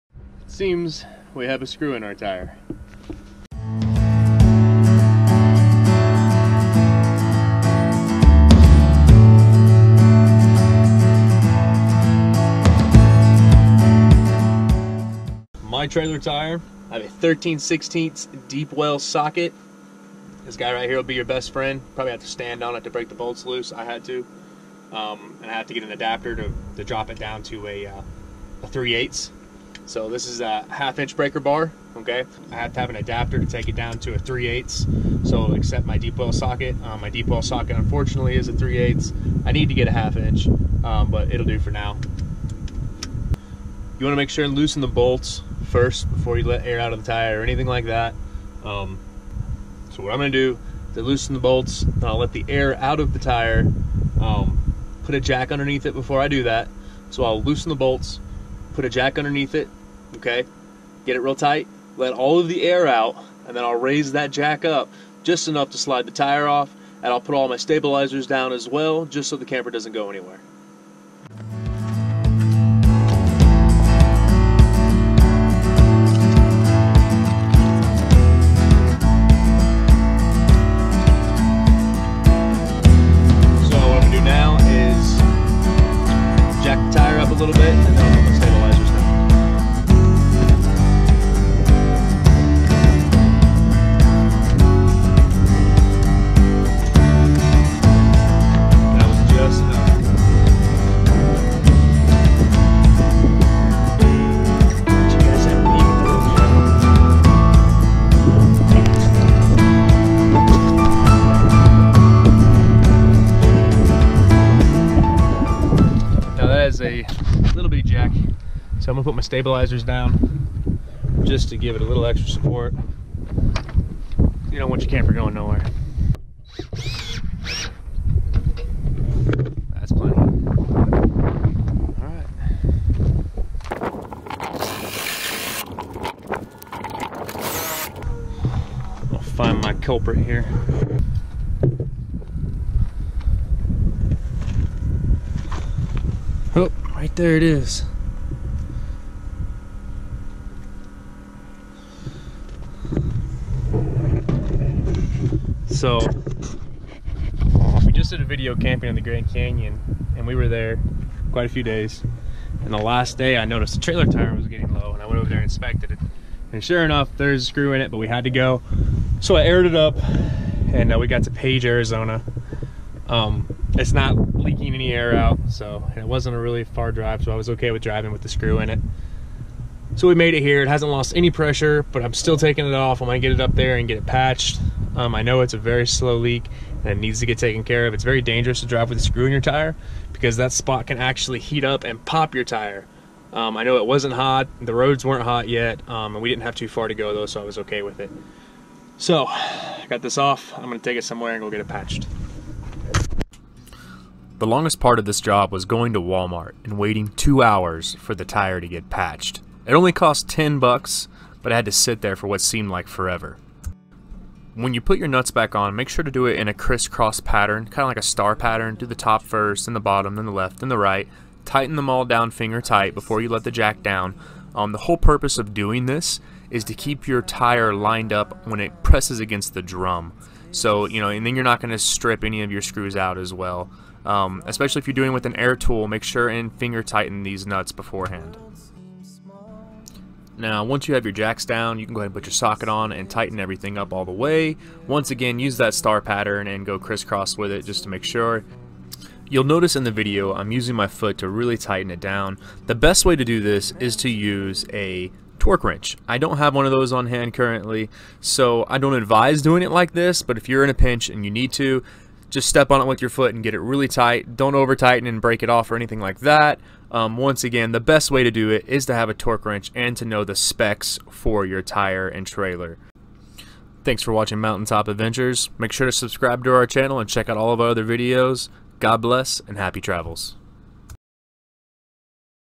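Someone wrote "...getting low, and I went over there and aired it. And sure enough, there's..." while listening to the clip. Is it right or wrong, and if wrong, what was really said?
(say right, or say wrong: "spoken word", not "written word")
wrong: "inspected", not "aired".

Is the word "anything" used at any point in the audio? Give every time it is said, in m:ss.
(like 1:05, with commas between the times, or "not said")
0:47, 4:25.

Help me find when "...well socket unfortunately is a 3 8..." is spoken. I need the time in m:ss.
0:37.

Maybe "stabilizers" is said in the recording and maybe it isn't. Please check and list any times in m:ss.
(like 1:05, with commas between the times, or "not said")
1:07, 1:59.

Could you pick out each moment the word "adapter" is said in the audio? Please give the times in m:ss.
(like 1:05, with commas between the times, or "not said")
0:25, 0:32.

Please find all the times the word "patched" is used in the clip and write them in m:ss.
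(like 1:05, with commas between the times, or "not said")
3:04, 3:21, 3:28.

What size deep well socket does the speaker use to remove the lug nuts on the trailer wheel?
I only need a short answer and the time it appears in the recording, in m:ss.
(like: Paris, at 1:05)
13/16, at 0:17.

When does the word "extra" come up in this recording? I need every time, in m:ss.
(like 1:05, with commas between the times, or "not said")
2:02.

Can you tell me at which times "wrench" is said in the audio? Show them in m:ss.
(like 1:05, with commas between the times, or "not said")
4:15, 4:29.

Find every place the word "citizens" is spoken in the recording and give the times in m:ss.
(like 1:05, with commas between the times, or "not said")
not said.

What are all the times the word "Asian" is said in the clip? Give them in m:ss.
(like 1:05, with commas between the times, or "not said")
not said.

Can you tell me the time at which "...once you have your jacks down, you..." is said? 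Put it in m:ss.
4:00.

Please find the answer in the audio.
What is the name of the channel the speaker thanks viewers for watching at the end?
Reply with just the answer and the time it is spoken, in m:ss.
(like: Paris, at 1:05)
Mountaintop Adventures, at 4:34.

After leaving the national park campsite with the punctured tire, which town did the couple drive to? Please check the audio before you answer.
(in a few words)
Page, Arizona.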